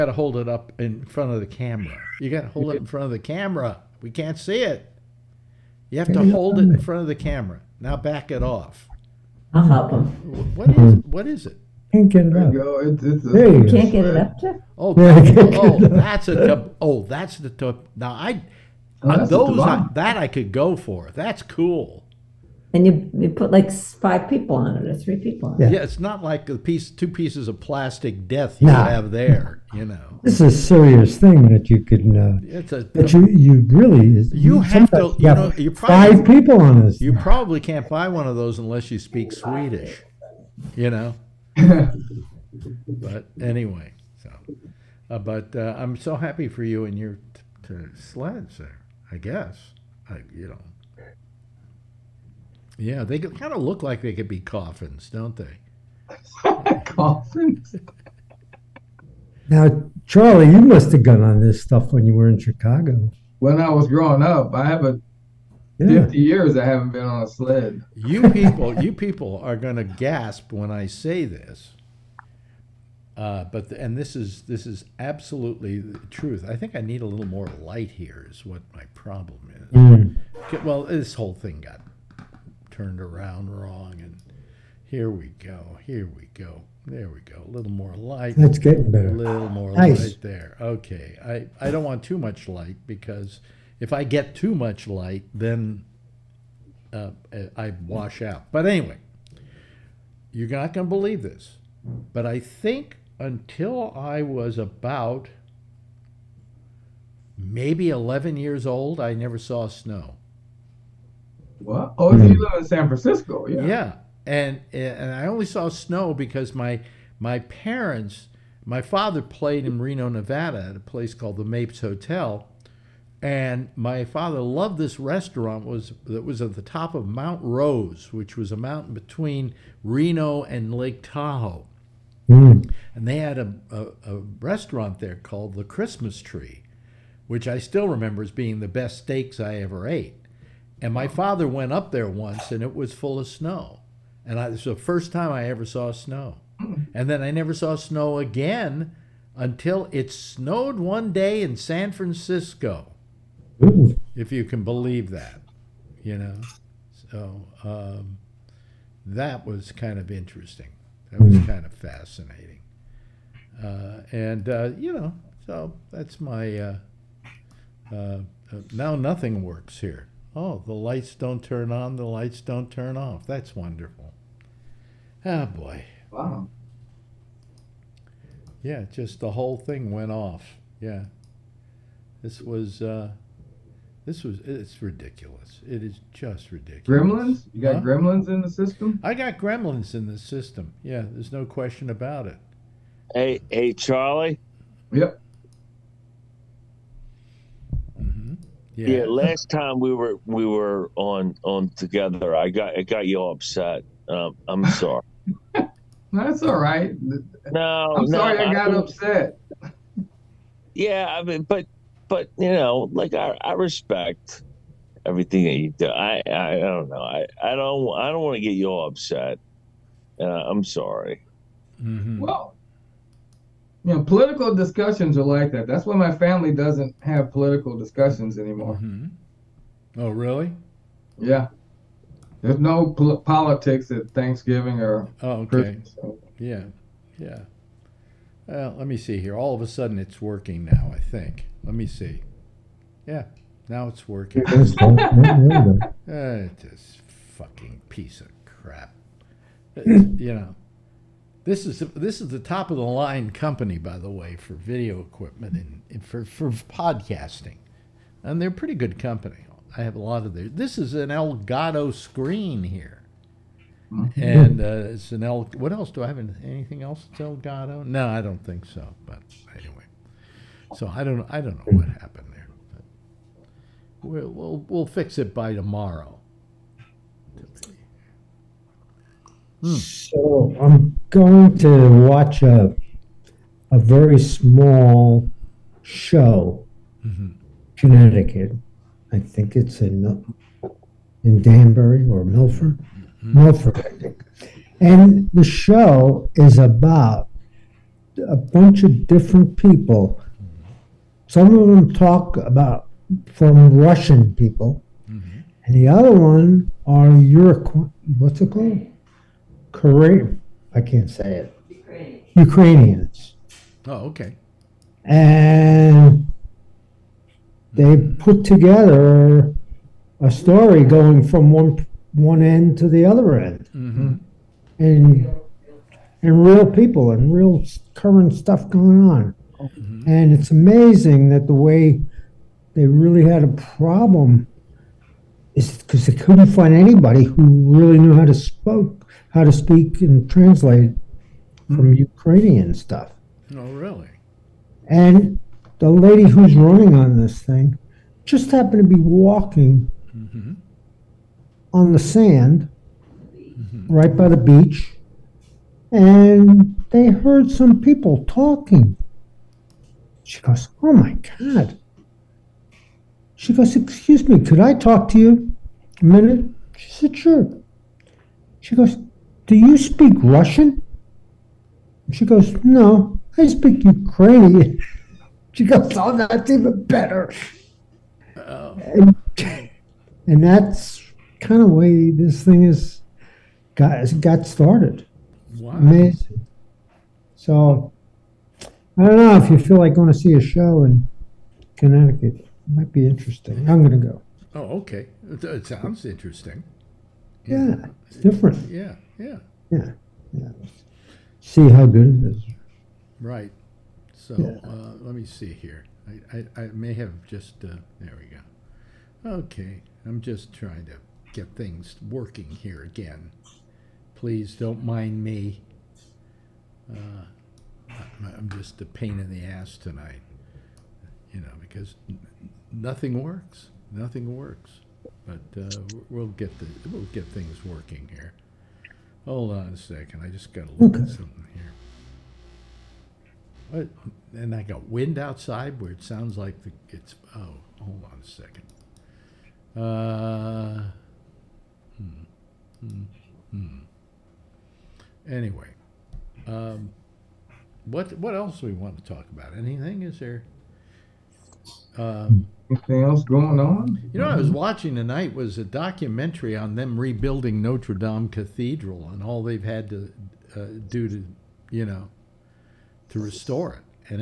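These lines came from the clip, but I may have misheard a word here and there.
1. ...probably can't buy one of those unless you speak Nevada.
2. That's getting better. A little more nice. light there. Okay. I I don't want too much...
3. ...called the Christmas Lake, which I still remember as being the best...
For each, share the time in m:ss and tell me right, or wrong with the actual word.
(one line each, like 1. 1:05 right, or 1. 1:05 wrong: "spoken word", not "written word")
1. 0:37 wrong: "Swedish", not "Nevada"
2. 1:28 right
3. 2:15 wrong: "Tree", not "Lake".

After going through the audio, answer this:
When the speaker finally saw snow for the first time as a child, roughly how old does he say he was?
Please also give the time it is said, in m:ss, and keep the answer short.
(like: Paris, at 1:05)
11, at 1:47.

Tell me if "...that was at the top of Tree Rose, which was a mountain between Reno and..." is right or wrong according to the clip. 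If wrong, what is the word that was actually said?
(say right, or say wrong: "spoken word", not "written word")
wrong: "Mount", not "Tree".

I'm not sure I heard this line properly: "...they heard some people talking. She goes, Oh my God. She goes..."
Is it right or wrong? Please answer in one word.
right.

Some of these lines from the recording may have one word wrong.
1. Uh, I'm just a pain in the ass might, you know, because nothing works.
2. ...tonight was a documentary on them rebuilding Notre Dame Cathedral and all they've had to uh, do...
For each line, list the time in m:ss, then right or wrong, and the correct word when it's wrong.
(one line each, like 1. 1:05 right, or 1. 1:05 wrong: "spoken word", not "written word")
1. 6:56 wrong: "tonight", not "might"
2. 7:34 right.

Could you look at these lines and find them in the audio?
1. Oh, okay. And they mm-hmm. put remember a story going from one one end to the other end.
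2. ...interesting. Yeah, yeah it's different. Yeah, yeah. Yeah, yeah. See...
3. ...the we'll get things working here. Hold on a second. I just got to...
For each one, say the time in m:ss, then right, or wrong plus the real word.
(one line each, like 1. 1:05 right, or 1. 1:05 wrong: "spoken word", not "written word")
1. 5:13 wrong: "together", not "remember"
2. 6:36 right
3. 7:06 right.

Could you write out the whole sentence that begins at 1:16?
I think I need a little more light here.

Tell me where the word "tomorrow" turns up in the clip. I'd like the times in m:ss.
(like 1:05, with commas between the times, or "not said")
4:35.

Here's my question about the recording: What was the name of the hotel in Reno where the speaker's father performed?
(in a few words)
Mapes Hotel.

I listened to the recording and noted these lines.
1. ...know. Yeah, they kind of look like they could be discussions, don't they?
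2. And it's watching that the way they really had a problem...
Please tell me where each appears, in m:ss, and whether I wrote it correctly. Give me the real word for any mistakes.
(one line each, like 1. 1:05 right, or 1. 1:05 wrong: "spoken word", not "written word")
1. 0:50 wrong: "coffins", not "discussions"
2. 5:30 wrong: "amazing", not "watching".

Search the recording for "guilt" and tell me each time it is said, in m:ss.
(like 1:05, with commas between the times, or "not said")
not said.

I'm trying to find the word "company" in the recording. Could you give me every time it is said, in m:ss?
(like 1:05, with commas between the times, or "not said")
4:13, 4:18.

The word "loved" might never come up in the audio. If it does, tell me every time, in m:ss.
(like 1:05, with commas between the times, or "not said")
2:04.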